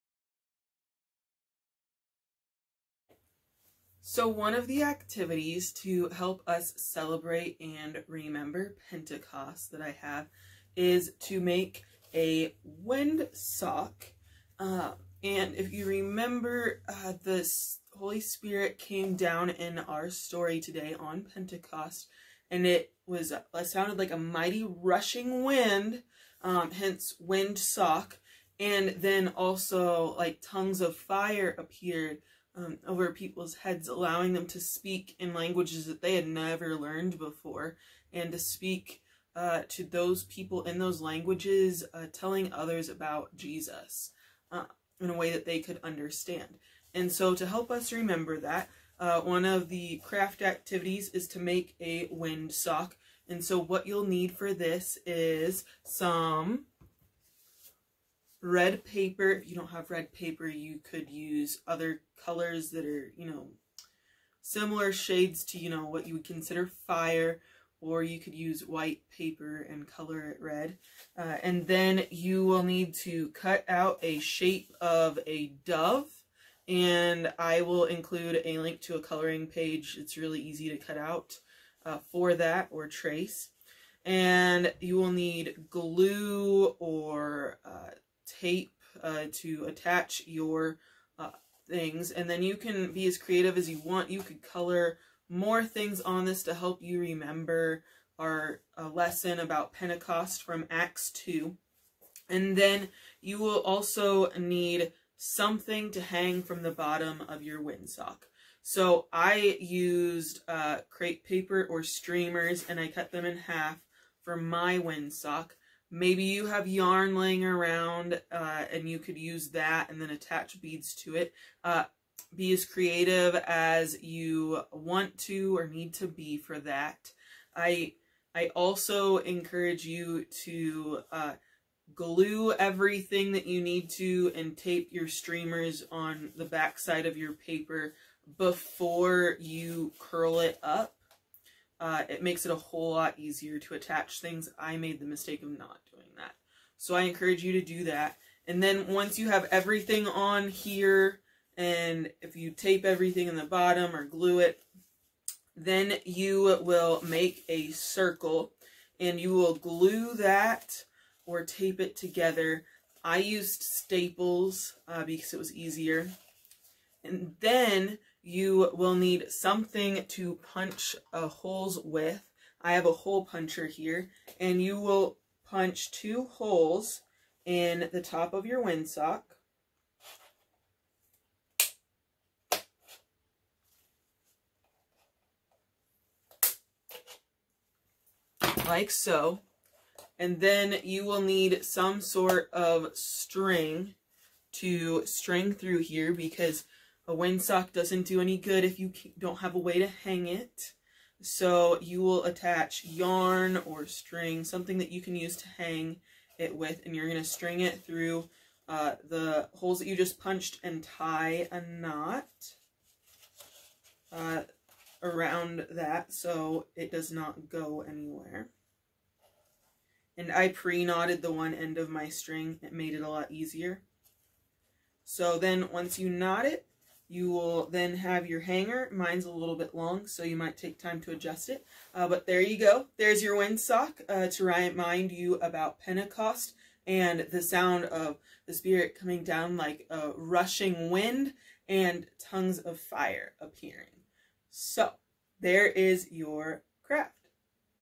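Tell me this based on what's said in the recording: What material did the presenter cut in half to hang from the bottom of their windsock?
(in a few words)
Crepe paper or streamers.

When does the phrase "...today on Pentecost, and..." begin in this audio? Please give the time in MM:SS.
00:20.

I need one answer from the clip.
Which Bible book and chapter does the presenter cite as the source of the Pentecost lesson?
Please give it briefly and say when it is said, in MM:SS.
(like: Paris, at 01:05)
Acts 2, at 01:40.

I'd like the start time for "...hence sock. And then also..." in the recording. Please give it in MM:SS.
00:26.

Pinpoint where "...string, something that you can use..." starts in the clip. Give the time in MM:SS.
03:23.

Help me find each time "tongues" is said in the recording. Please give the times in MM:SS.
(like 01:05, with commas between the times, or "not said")
00:30, 04:02.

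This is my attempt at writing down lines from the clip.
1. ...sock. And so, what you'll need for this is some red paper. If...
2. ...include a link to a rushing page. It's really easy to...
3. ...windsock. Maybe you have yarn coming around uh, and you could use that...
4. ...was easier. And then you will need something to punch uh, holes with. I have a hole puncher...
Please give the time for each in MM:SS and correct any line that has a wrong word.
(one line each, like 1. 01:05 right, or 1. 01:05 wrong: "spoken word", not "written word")
1. 00:52 right
2. 01:17 wrong: "coloring", not "rushing"
3. 01:54 wrong: "laying", not "coming"
4. 02:45 right.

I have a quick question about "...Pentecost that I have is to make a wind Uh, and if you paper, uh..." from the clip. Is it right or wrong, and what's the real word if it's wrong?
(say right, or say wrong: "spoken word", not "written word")
wrong: "remember", not "paper".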